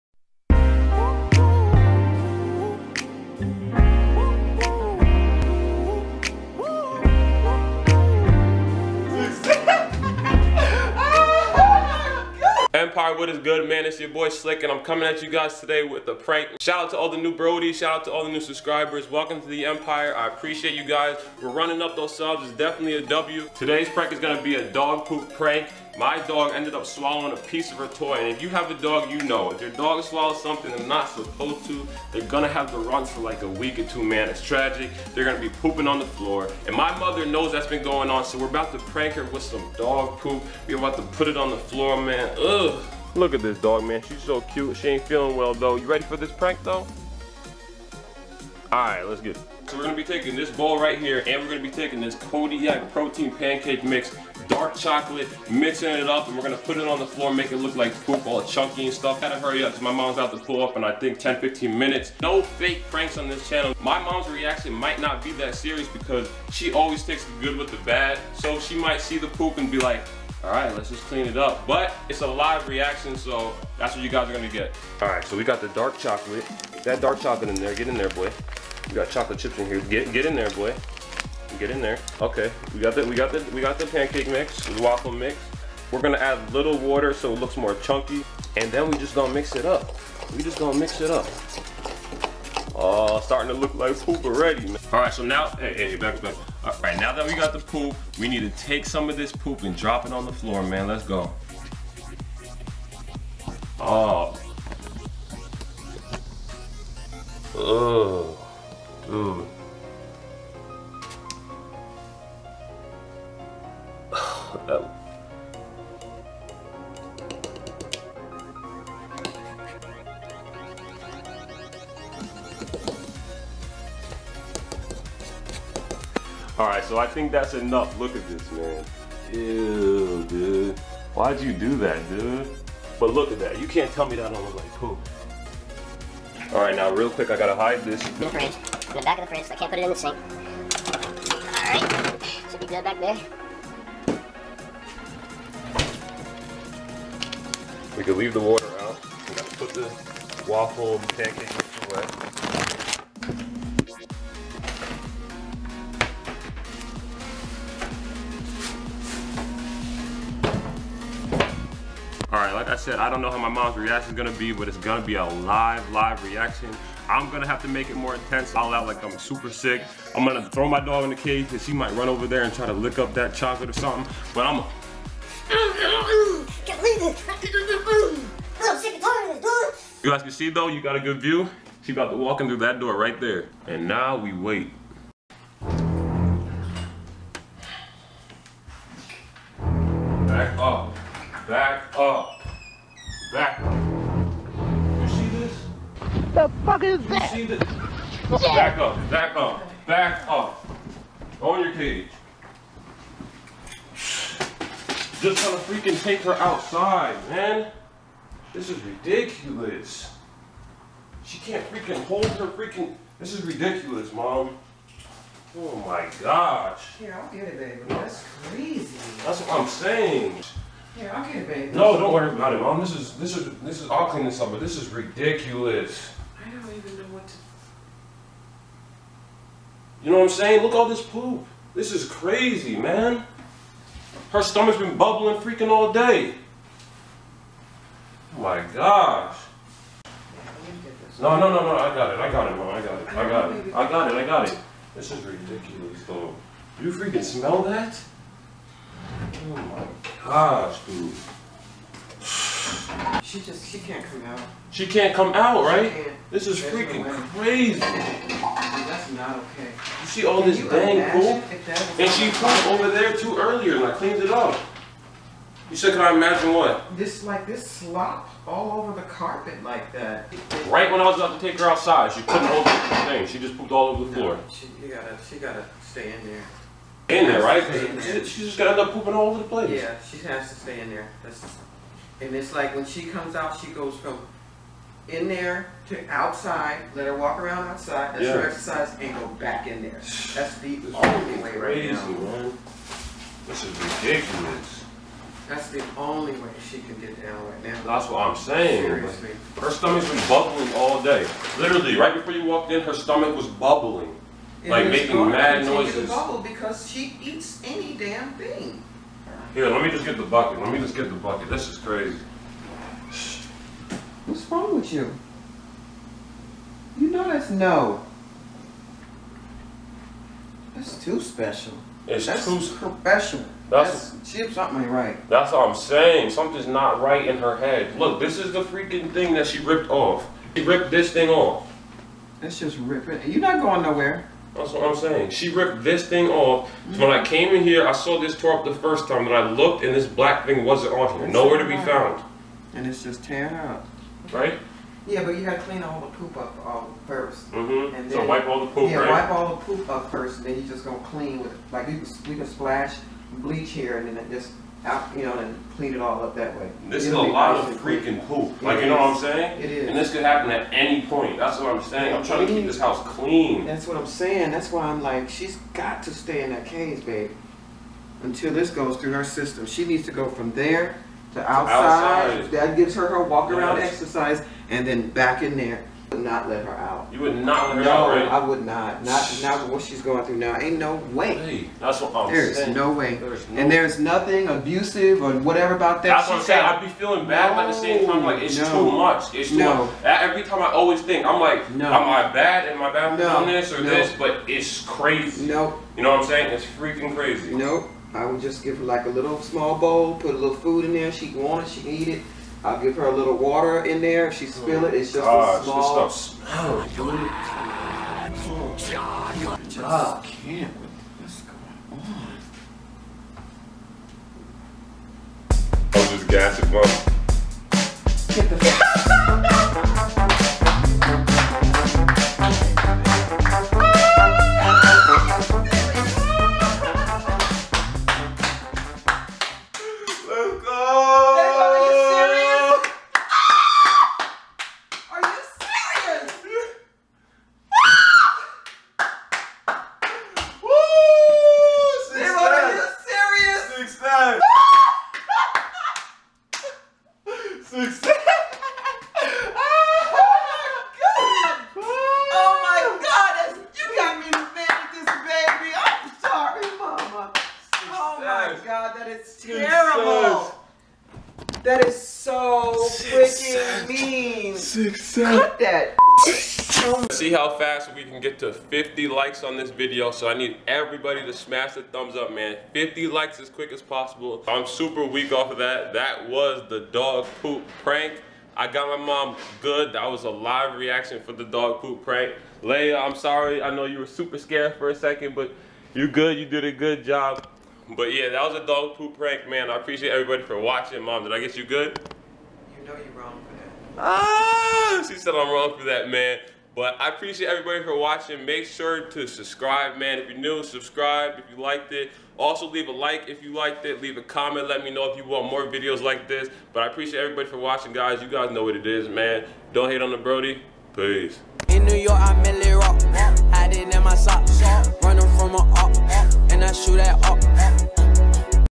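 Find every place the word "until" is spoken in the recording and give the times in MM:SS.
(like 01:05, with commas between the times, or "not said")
06:08.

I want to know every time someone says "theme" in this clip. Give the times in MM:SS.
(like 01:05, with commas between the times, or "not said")
not said.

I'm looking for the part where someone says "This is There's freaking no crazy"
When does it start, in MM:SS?
04:16.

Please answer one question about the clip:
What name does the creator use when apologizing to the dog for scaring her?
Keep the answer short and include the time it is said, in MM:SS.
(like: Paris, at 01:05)
Leia, at 08:02.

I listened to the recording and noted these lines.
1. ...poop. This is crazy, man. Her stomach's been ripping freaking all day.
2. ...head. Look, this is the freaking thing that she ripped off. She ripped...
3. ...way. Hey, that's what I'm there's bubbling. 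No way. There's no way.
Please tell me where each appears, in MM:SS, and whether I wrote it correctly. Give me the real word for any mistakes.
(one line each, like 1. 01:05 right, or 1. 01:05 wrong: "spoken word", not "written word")
1. 03:51 wrong: "bubbling", not "ripping"
2. 05:27 right
3. 06:21 wrong: "saying", not "bubbling".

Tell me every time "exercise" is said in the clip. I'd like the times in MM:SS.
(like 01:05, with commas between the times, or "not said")
04:48, 06:13.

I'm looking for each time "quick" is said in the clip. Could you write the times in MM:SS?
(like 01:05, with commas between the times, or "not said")
02:17, 07:53.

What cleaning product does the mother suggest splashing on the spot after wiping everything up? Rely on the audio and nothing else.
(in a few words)
bleach.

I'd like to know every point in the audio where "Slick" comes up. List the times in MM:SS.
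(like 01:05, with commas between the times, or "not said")
00:14.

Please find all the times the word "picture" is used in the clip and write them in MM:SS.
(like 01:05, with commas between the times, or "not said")
not said.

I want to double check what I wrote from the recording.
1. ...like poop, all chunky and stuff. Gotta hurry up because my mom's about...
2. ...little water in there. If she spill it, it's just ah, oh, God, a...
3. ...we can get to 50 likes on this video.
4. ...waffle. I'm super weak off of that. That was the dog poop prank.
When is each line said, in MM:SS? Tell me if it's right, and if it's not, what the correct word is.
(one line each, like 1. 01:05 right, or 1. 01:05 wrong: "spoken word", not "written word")
1. 00:57 right
2. 06:43 right
3. 07:47 right
4. 07:53 wrong: "possible", not "waffle".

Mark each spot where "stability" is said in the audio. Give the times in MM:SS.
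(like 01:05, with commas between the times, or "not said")
not said.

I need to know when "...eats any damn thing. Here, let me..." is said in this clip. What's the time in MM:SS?
05:07.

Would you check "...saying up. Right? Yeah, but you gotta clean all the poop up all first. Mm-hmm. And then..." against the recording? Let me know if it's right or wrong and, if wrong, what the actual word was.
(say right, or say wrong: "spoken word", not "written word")
wrong: "tearing", not "saying".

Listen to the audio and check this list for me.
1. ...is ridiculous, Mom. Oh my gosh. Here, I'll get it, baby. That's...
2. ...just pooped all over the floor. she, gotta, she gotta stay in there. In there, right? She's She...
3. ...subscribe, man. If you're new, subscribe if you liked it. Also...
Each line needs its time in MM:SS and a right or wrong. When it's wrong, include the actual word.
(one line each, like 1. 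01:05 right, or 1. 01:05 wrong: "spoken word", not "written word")
1. 03:33 right
2. 04:33 right
3. 08:19 right.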